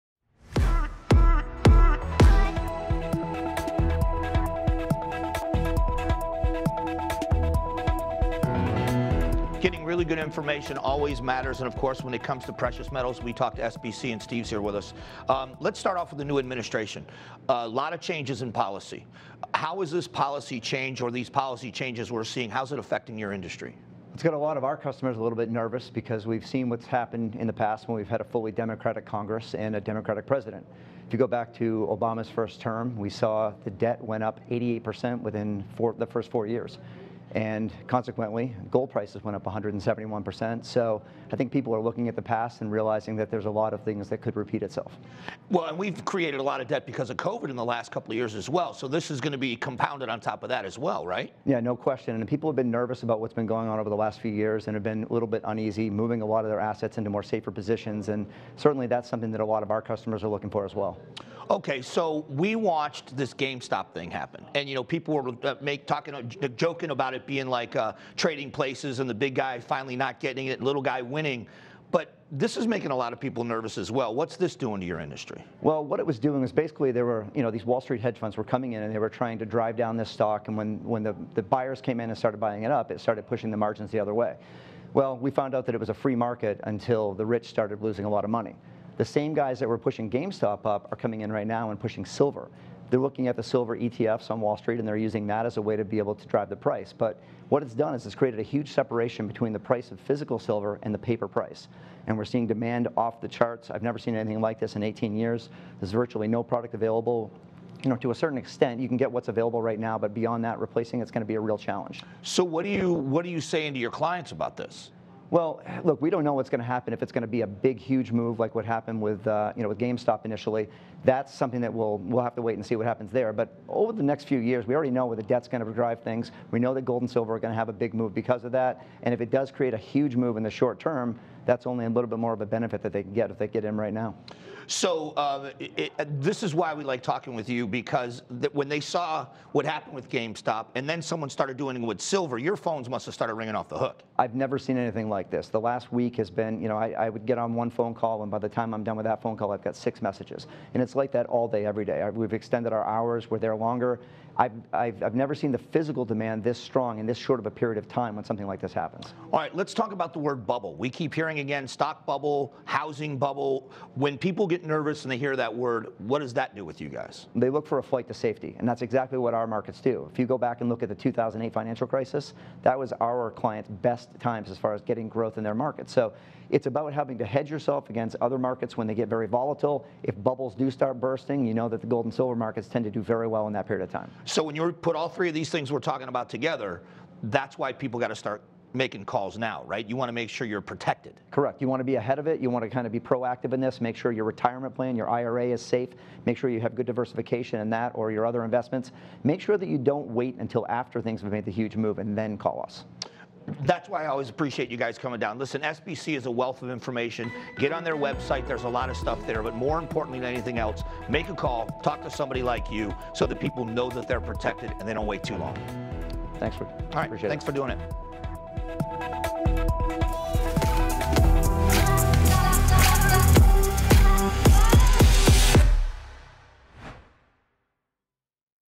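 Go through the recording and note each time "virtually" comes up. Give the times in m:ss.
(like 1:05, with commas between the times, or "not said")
1:45.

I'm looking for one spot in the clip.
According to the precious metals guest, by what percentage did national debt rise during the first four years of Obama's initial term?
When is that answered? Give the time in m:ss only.
0:34.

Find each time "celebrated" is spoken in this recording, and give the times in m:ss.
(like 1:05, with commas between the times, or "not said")
not said.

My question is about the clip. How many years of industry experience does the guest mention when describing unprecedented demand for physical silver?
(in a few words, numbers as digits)
18 years.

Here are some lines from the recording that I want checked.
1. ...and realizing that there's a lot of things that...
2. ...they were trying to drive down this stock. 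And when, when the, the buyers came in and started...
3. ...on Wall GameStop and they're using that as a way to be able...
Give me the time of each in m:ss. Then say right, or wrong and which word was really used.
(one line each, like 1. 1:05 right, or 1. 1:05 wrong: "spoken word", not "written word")
1. 0:42 right
2. 1:18 right
3. 1:34 wrong: "Street", not "GameStop".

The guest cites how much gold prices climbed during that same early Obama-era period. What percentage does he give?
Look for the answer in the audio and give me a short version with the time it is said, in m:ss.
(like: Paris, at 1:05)
171%, at 0:39.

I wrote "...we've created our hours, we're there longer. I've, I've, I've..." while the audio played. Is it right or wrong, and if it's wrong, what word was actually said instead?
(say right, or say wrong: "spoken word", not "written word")
wrong: "extended", not "created".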